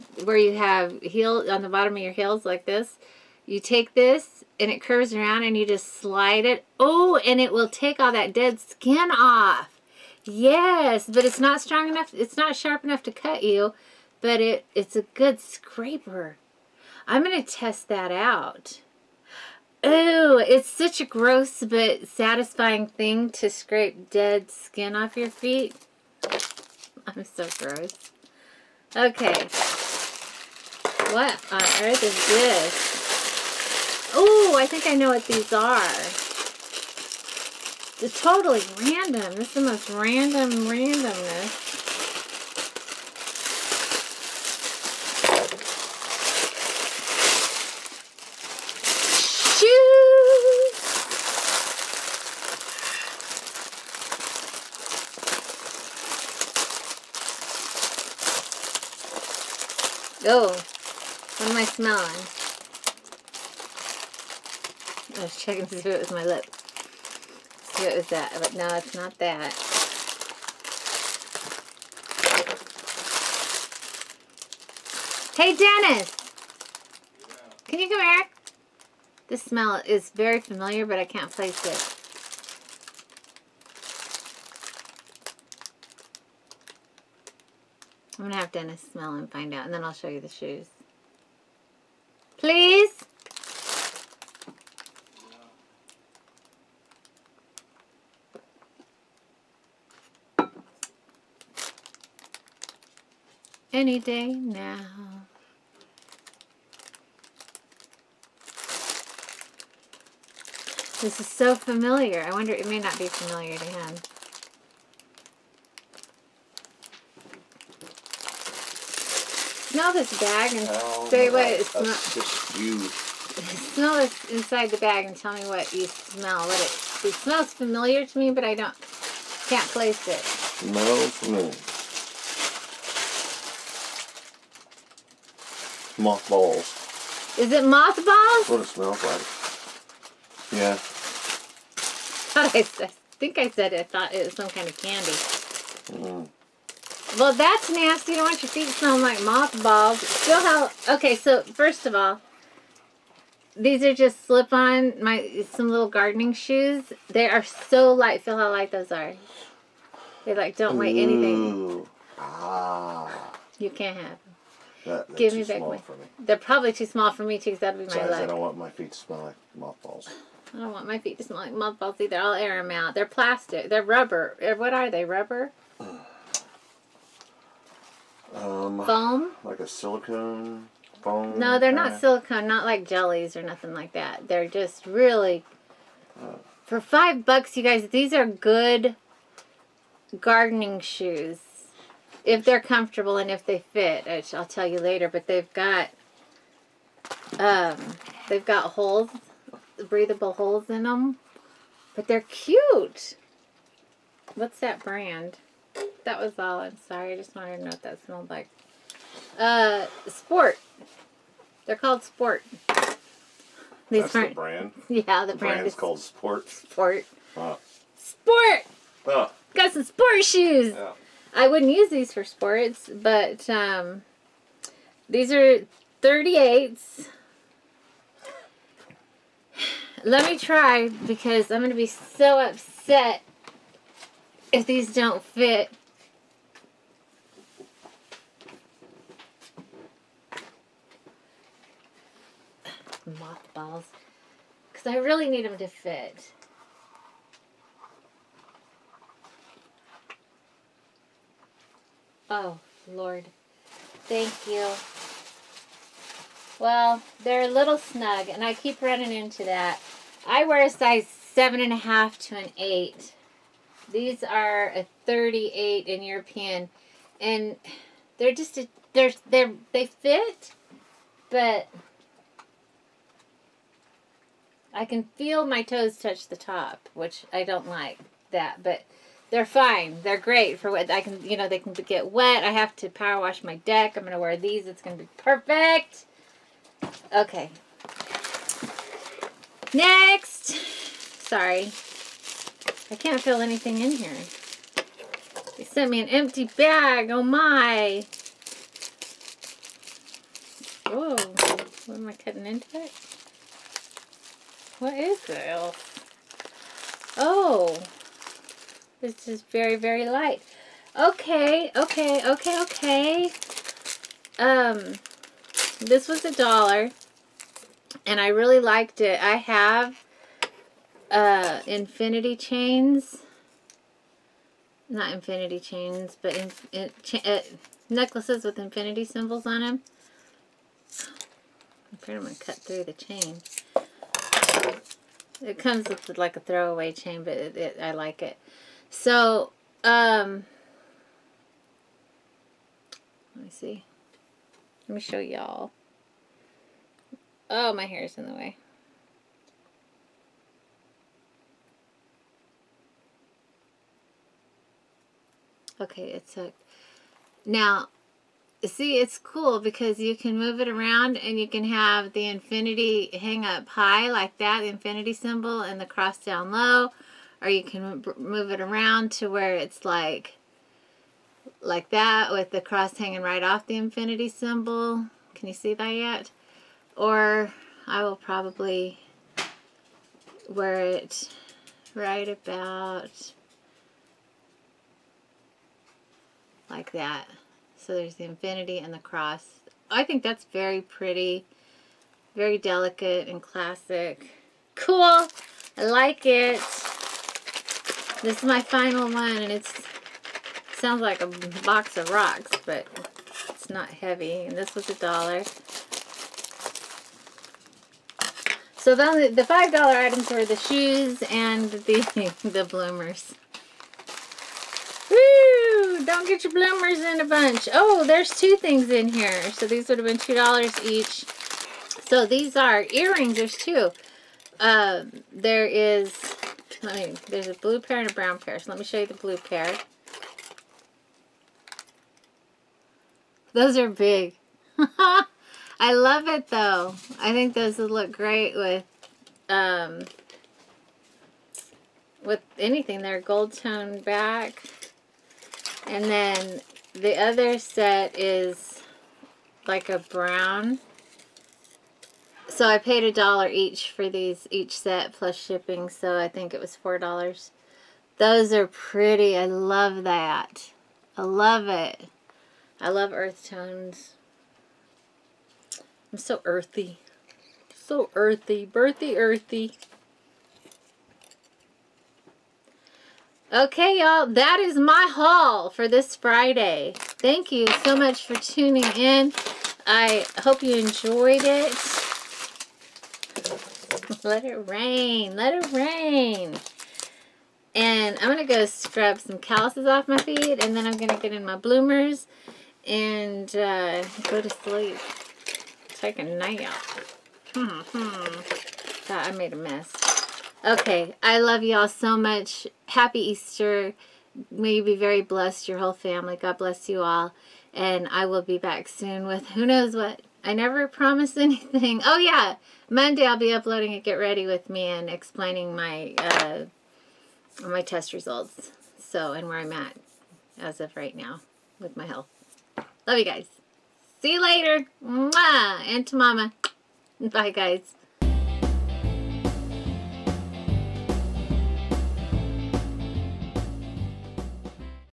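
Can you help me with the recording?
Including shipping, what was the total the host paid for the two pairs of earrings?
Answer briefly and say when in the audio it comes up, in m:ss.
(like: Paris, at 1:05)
$4, at 7:36.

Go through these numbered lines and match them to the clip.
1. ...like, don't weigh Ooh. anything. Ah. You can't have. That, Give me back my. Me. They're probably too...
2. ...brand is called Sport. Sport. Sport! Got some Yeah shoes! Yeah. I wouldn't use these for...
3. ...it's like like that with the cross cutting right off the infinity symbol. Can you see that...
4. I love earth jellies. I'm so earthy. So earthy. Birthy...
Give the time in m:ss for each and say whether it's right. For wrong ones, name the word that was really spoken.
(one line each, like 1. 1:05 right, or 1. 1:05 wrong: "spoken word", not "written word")
1. 2:40 right
2. 3:35 wrong: "Sport", not "Yeah"
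3. 6:09 wrong: "hanging", not "cutting"
4. 7:42 wrong: "tones", not "jellies".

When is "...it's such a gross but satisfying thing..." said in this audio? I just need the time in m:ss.
0:20.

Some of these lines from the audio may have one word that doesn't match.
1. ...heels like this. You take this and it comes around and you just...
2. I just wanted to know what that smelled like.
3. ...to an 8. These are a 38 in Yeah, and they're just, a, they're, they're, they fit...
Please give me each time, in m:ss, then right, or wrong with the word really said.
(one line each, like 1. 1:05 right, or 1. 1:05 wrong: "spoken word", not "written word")
1. 0:02 wrong: "curves", not "comes"
2. 3:27 right
3. 4:22 wrong: "European", not "Yeah".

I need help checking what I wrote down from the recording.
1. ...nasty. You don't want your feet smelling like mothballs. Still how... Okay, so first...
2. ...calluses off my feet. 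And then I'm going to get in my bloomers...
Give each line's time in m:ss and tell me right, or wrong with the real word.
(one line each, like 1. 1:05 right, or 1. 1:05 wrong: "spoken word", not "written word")
1. 2:27 right
2. 8:09 right.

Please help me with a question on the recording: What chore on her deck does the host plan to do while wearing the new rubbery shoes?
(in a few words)
Power wash.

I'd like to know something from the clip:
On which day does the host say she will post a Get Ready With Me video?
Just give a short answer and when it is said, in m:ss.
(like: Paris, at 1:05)
Monday, at 8:32.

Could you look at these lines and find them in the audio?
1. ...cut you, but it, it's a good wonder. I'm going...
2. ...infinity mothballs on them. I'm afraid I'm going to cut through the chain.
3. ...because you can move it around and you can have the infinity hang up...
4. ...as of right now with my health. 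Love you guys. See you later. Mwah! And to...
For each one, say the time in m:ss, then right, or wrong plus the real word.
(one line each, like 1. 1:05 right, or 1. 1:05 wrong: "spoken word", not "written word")
1. 0:13 wrong: "scraper", not "wonder"
2. 5:28 wrong: "symbols", not "mothballs"
3. 5:59 right
4. 8:40 right.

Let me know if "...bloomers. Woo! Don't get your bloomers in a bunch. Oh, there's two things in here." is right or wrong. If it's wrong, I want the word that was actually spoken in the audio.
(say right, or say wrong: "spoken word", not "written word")
right.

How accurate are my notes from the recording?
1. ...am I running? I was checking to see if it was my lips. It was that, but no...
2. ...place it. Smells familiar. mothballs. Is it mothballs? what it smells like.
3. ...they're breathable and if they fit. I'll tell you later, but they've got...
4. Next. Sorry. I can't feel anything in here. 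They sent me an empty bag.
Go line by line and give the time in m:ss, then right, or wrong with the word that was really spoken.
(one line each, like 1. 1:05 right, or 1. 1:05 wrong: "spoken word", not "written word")
1. 1:01 wrong: "smelling", not "running"
2. 2:09 right
3. 3:12 wrong: "comfortable", not "breathable"
4. 4:49 right.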